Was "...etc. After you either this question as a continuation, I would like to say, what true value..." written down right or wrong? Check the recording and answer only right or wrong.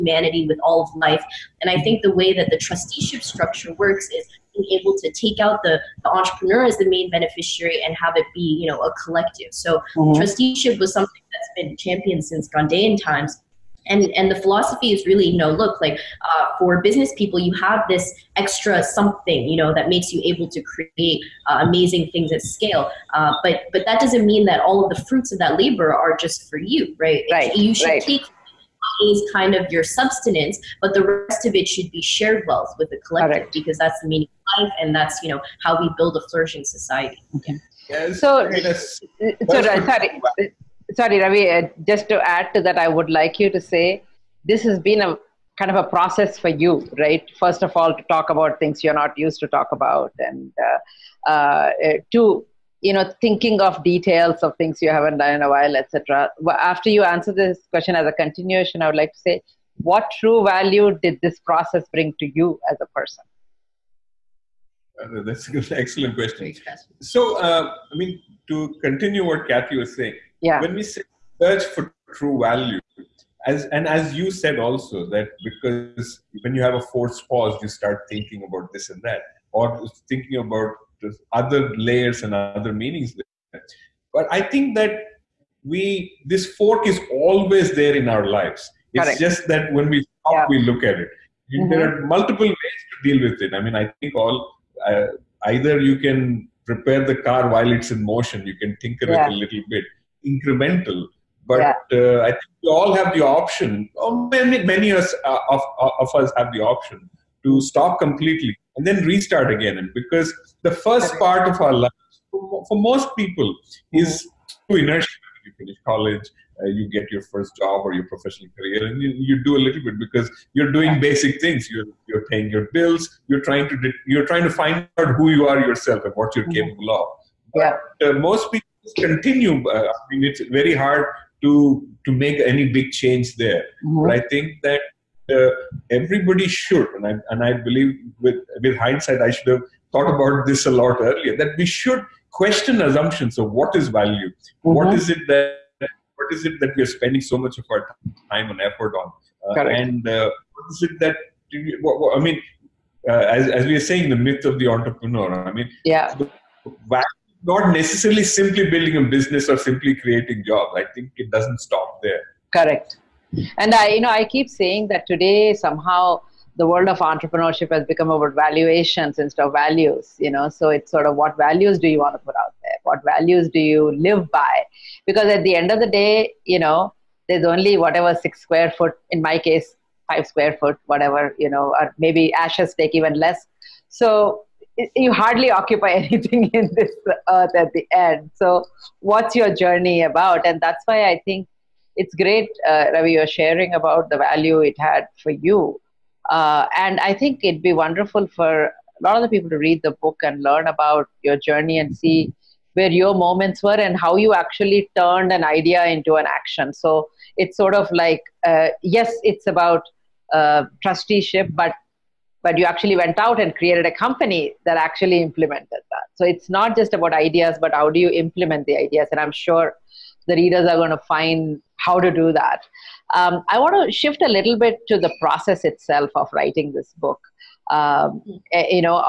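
wrong.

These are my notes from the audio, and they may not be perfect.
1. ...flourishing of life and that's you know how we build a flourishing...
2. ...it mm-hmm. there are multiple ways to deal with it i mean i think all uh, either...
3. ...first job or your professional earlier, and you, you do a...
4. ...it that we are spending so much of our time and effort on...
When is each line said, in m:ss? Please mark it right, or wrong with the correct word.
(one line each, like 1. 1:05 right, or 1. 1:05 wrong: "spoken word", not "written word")
1. 0:34 wrong: "meaning", not "flourishing"
2. 1:31 right
3. 1:57 wrong: "career", not "earlier"
4. 2:26 right.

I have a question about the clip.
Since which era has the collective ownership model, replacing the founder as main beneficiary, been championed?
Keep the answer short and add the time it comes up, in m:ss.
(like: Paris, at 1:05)
Gandhian times, at 0:12.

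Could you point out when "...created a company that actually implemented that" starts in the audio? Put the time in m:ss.
3:33.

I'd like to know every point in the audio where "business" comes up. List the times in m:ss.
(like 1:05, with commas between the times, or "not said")
0:16, 2:39.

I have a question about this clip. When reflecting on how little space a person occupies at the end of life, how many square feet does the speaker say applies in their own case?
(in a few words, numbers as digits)
5.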